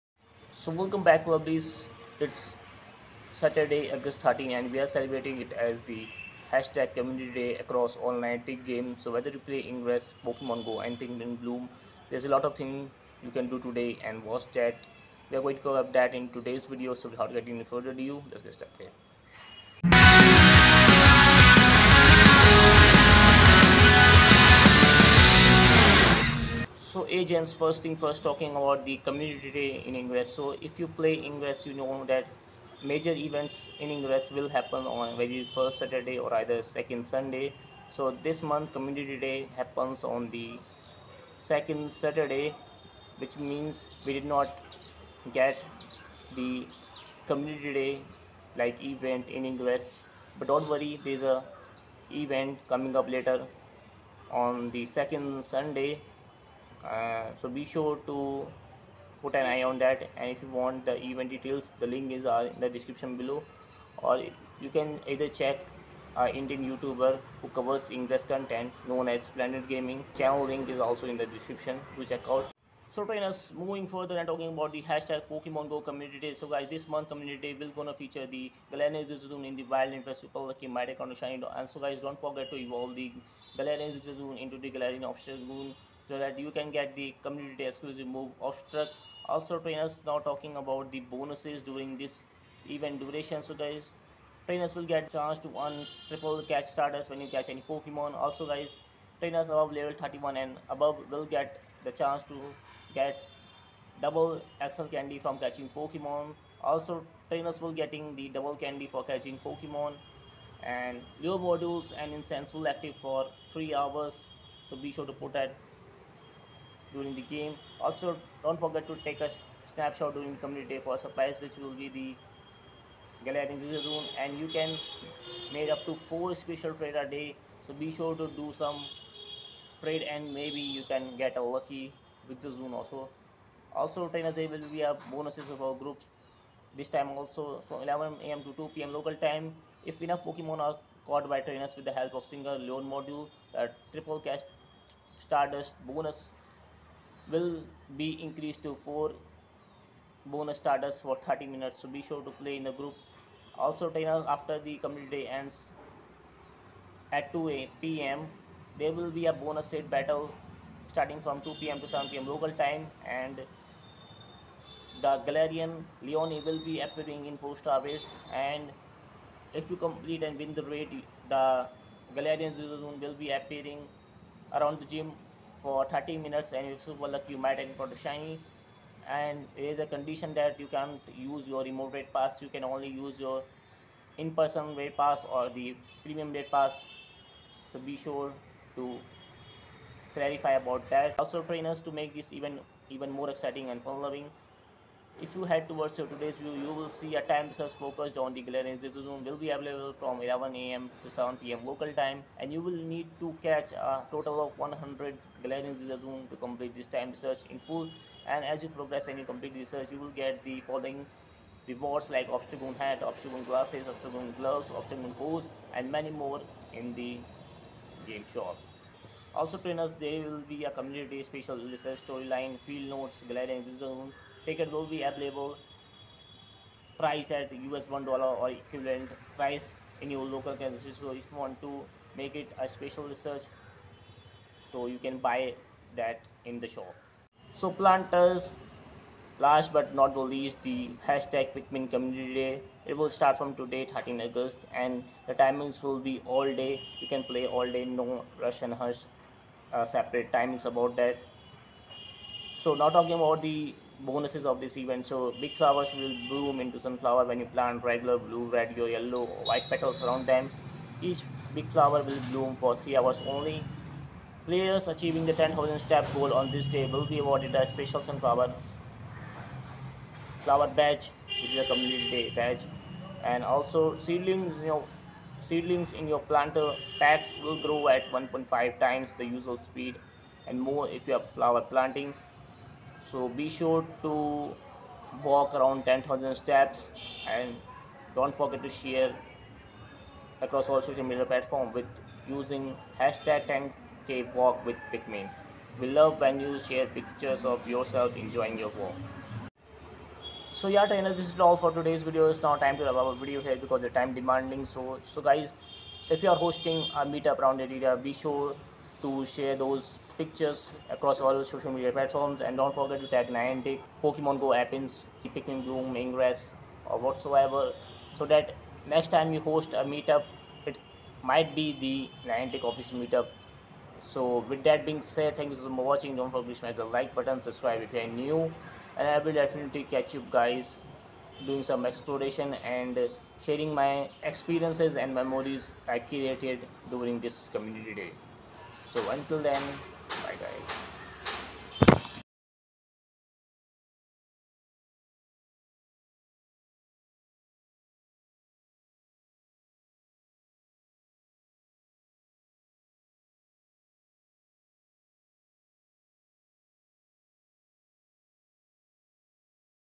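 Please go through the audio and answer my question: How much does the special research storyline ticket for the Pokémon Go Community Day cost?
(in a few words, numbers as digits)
US$1.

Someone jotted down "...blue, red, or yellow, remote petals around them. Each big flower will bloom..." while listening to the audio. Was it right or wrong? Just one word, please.
wrong.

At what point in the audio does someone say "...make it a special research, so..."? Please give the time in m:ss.
3:52.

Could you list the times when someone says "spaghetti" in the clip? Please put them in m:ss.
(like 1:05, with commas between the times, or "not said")
not said.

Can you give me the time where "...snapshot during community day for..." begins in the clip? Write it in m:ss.
1:59.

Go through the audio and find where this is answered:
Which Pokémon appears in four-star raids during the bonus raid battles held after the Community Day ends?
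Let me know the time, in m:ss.
2:45.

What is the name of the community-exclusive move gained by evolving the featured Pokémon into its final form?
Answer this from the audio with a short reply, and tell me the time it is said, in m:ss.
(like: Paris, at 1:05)
Obstruct, at 1:28.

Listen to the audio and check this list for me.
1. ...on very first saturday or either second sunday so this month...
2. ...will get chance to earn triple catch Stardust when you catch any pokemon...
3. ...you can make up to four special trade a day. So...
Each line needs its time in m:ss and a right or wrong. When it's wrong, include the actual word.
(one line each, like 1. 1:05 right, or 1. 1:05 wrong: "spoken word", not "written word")
1. 0:34 right
2. 1:34 right
3. 2:04 right.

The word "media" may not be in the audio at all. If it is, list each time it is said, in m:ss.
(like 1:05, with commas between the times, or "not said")
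4:51, 5:11.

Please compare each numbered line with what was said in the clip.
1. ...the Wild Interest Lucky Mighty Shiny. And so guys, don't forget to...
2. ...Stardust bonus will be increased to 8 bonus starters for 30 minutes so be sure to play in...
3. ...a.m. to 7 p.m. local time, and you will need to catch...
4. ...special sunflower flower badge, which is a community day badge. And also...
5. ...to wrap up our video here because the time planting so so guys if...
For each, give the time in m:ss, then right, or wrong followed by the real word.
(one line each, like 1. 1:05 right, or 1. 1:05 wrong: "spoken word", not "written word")
1. 1:19 right
2. 2:25 wrong: "4", not "8"
3. 3:20 right
4. 4:27 right
5. 5:02 wrong: "demanding", not "planting".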